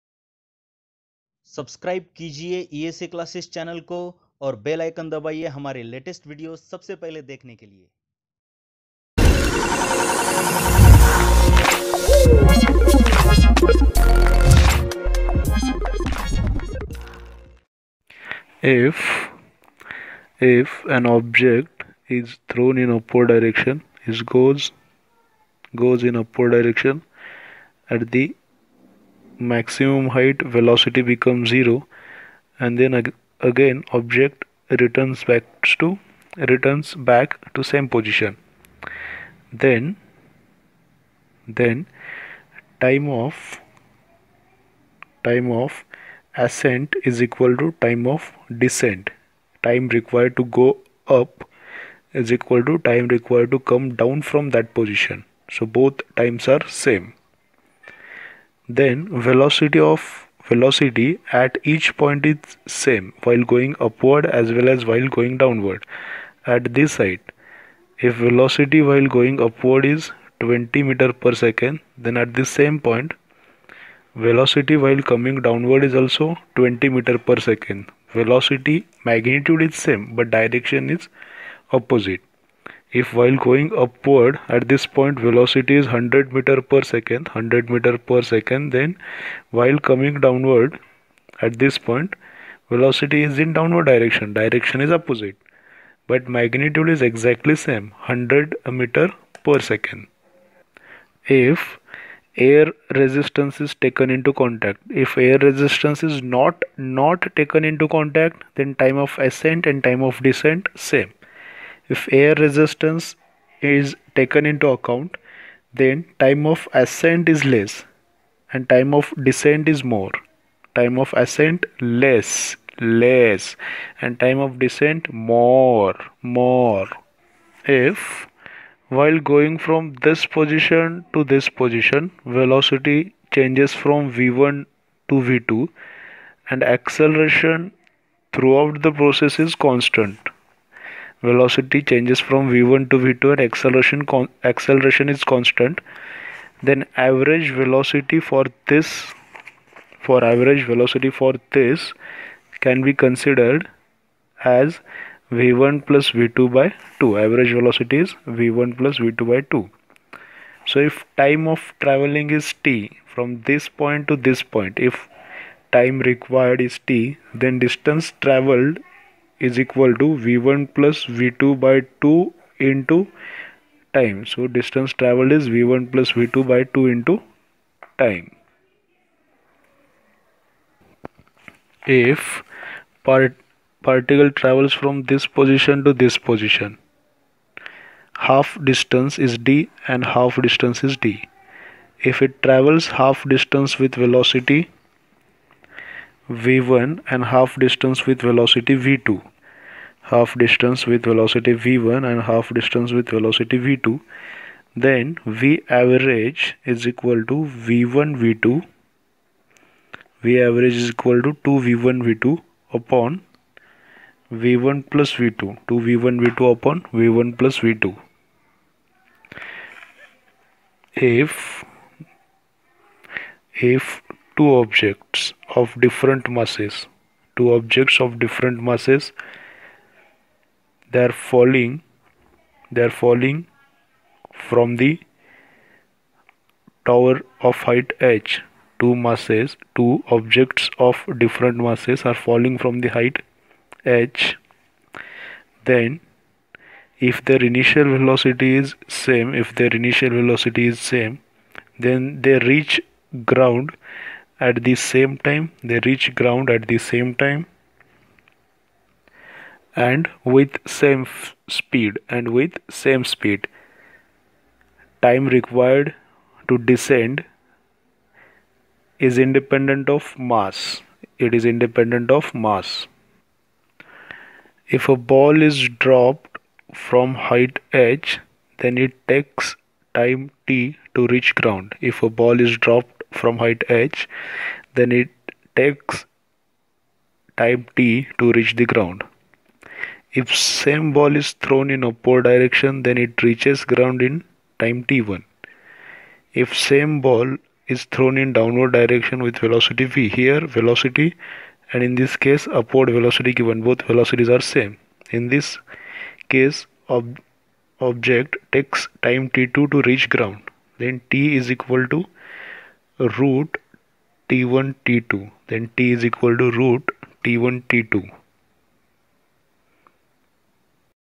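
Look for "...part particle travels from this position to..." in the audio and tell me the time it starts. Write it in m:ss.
3:03.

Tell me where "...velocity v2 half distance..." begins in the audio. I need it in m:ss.
3:18.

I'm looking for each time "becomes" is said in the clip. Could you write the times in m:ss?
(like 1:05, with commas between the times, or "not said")
0:31.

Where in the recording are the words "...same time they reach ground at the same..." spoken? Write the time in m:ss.
4:14.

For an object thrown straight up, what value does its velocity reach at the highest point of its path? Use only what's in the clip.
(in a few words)
0.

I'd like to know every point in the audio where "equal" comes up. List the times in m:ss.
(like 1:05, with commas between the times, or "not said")
0:47, 0:52, 2:49, 3:26, 3:30, 5:11, 5:16.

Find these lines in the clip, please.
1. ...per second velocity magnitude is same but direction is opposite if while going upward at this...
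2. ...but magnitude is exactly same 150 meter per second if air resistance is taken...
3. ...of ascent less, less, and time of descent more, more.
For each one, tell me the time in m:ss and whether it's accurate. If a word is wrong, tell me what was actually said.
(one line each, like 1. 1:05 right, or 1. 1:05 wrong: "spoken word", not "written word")
1. 1:17 right
2. 1:36 wrong: "100", not "150"
3. 2:01 right.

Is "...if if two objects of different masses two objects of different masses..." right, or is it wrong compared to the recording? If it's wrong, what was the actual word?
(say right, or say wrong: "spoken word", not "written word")
right.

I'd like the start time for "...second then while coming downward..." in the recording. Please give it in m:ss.
1:28.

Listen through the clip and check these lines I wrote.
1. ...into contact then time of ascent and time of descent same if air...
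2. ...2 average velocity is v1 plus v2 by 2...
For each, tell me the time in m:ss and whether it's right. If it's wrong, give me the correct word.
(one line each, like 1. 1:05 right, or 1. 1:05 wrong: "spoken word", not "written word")
1. 1:47 right
2. 2:37 right.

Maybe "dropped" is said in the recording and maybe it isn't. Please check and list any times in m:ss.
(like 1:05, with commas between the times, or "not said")
4:35, 4:42.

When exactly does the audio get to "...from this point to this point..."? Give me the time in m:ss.
2:43.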